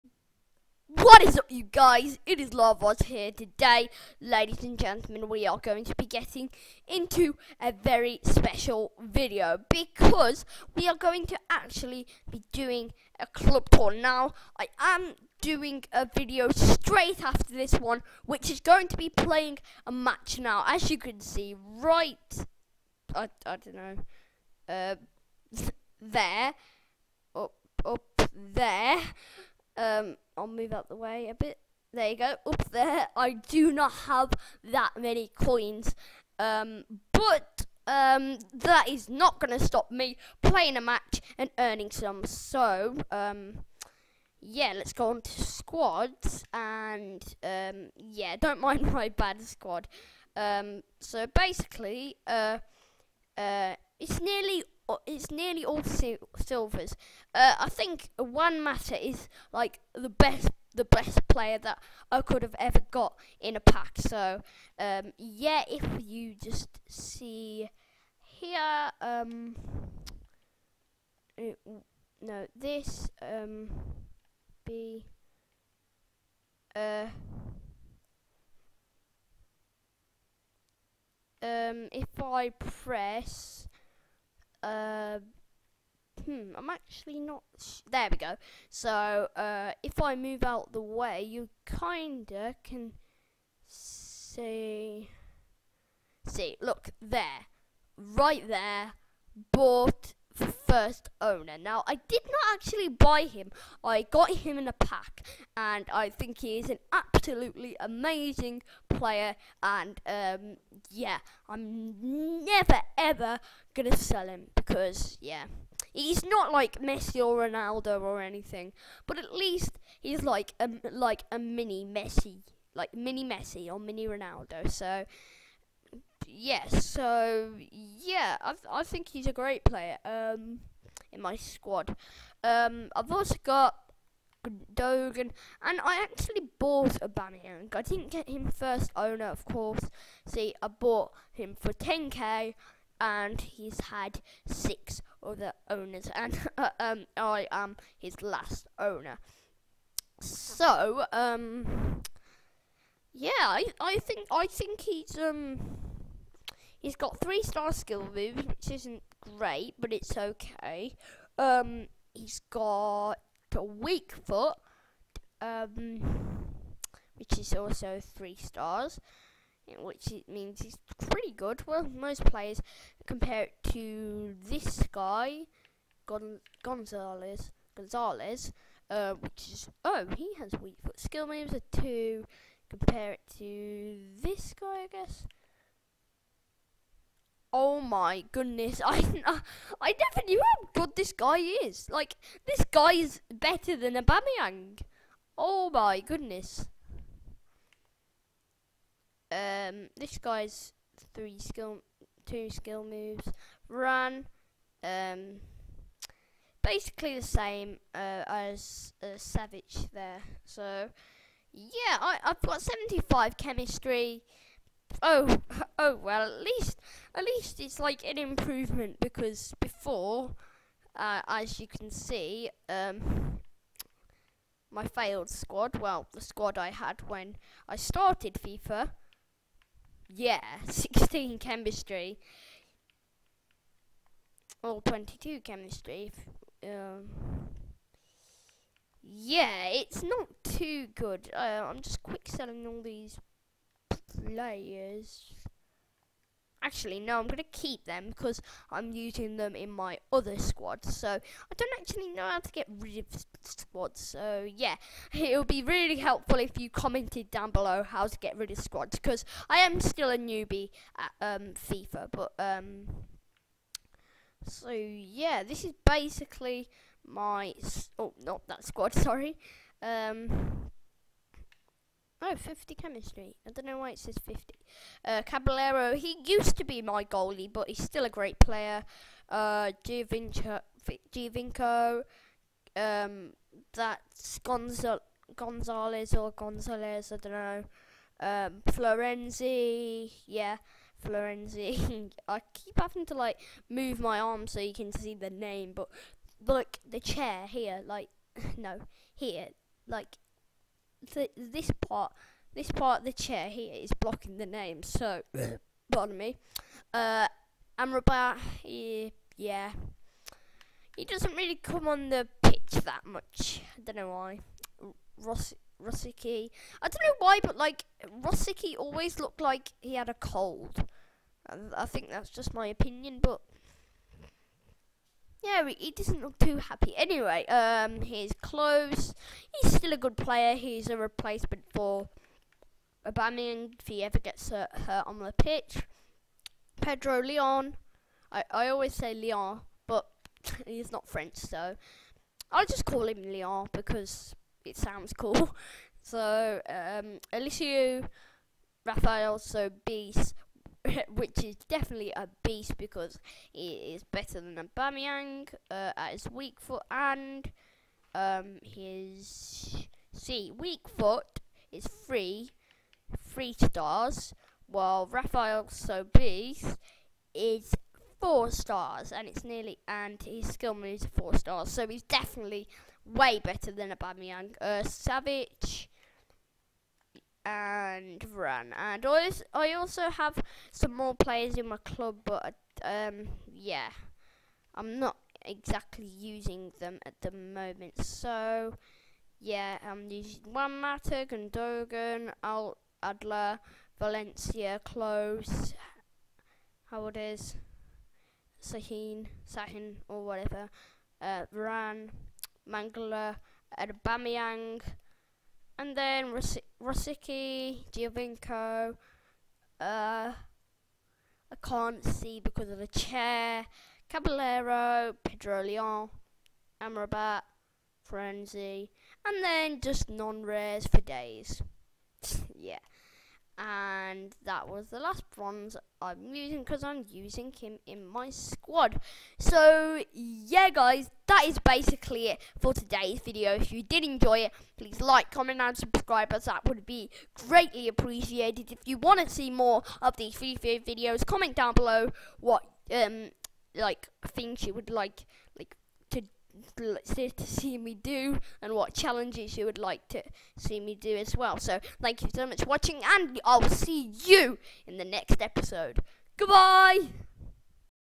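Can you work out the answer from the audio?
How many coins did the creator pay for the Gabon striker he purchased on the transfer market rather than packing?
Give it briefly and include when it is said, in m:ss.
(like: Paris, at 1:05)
10k, at 2:21.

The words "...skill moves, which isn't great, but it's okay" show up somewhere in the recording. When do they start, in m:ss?
2:37.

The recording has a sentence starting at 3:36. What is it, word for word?
At least, at least it's like an improvement because before, uh, as you can see, um, my failed squad.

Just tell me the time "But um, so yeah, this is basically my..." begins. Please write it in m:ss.
4:22.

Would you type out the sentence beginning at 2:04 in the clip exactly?
So yes, yeah, so yeah, I I think he's a great player.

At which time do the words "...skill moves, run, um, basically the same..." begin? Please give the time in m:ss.
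3:22.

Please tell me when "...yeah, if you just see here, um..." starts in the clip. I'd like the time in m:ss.
1:05.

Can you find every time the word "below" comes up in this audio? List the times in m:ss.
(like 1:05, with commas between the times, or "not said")
4:17, 7:21.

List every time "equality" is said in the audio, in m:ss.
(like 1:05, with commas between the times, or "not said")
not said.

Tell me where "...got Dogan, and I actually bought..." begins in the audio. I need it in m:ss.
2:13.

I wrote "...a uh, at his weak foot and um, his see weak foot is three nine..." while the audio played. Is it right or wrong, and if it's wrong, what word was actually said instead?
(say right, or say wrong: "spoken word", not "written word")
wrong: "three", not "nine".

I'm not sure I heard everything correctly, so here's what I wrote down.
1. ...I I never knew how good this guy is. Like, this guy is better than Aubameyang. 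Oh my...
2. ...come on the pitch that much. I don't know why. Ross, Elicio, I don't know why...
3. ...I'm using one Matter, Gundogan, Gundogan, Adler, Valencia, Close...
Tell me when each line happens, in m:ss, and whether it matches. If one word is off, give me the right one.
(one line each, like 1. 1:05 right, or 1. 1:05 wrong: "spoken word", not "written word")
1. 3:08 right
2. 5:11 wrong: "Rosicky", not "Elicio"
3. 6:29 wrong: "Alt", not "Gundogan".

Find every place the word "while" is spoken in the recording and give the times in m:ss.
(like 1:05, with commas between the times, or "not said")
6:04.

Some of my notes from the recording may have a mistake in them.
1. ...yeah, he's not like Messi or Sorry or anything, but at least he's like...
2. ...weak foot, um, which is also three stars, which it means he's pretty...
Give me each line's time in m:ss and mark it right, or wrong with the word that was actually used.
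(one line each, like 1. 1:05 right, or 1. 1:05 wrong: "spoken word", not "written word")
1. 1:55 wrong: "Ronaldo", not "Sorry"
2. 2:43 right.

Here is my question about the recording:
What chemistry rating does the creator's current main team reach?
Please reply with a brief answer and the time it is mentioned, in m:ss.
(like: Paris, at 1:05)
75, at 3:32.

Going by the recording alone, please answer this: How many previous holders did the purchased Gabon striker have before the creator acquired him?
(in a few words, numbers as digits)
6.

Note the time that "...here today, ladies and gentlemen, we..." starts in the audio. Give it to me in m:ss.
0:03.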